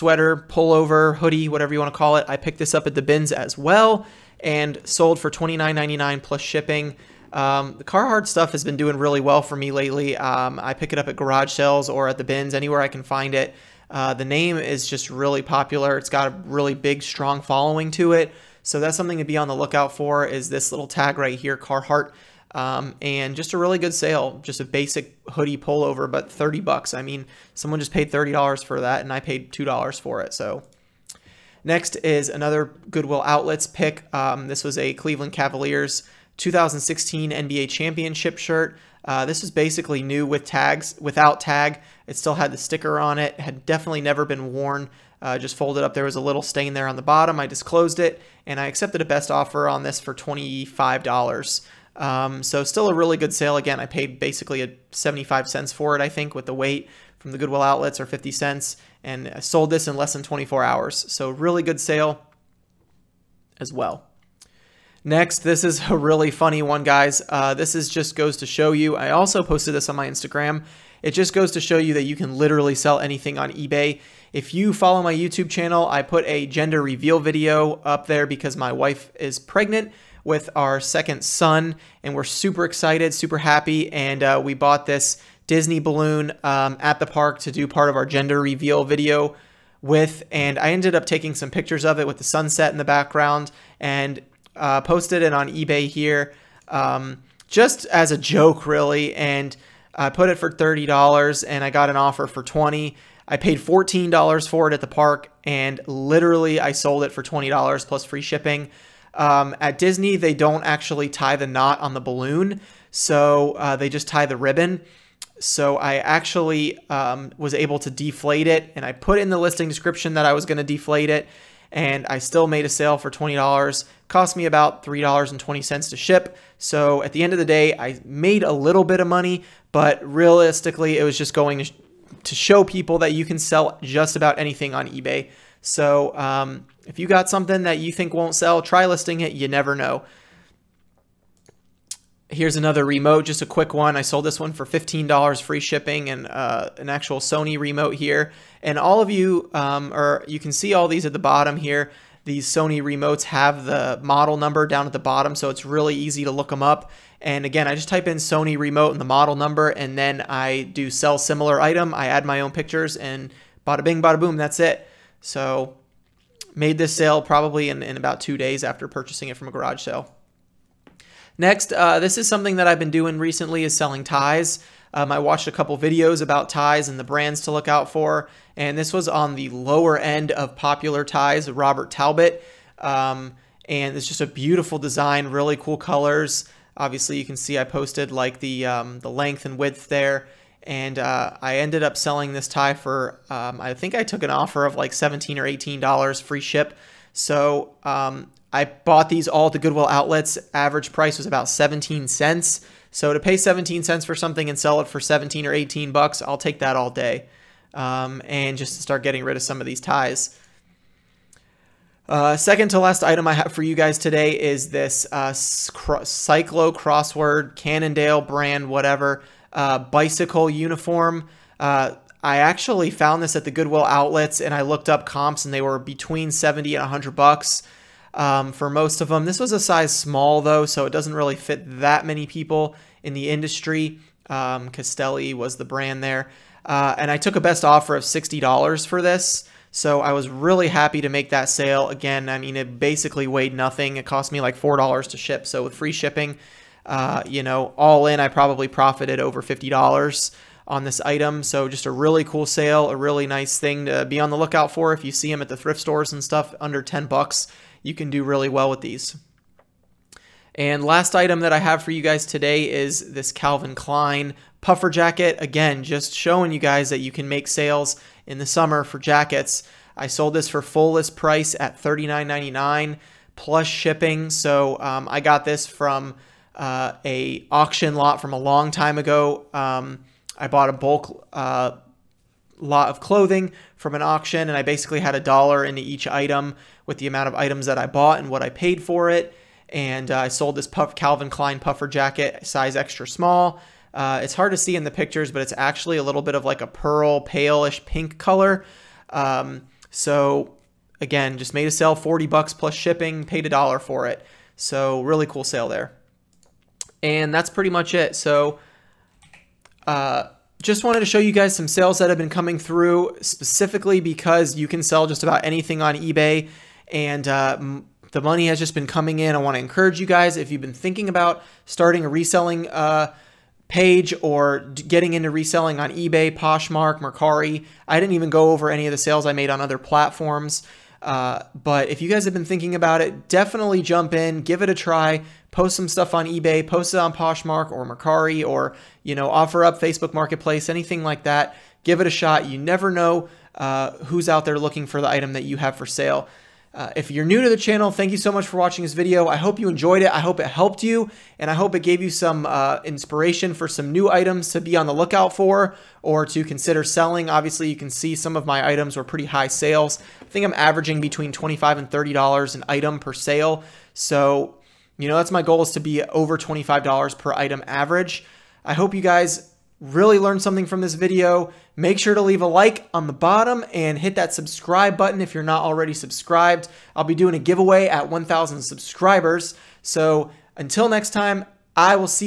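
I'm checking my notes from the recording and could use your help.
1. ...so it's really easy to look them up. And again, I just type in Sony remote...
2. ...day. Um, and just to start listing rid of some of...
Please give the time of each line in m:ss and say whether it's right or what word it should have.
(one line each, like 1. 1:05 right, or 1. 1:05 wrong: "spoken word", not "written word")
1. 2:35 right
2. 3:26 wrong: "getting", not "listing".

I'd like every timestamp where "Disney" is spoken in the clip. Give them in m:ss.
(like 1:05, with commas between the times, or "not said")
1:25, 1:49.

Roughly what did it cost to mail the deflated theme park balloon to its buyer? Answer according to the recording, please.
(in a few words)
$3.20.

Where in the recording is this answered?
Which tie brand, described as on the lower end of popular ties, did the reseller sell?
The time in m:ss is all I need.
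3:01.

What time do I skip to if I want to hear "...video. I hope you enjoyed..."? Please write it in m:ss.
5:48.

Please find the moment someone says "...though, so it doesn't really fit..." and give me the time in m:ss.
3:50.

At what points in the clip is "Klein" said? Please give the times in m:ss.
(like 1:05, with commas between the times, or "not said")
4:23, 4:51.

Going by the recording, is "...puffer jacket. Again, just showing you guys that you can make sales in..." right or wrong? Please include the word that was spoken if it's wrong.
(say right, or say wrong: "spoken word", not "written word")
right.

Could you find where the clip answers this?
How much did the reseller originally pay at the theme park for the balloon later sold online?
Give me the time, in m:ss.
1:43.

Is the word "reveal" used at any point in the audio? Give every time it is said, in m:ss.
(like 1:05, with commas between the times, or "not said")
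1:16, 1:28.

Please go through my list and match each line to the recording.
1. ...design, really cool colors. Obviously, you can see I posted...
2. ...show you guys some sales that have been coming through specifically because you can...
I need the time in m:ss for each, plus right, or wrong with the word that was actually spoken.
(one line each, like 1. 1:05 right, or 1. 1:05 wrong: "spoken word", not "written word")
1. 3:04 right
2. 5:11 right.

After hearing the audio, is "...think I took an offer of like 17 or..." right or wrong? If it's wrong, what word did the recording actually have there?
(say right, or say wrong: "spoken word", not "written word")
right.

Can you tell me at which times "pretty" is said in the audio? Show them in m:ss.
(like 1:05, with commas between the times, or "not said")
5:07, 5:59.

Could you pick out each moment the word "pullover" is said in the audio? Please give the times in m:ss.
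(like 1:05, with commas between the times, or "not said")
0:00, 0:25.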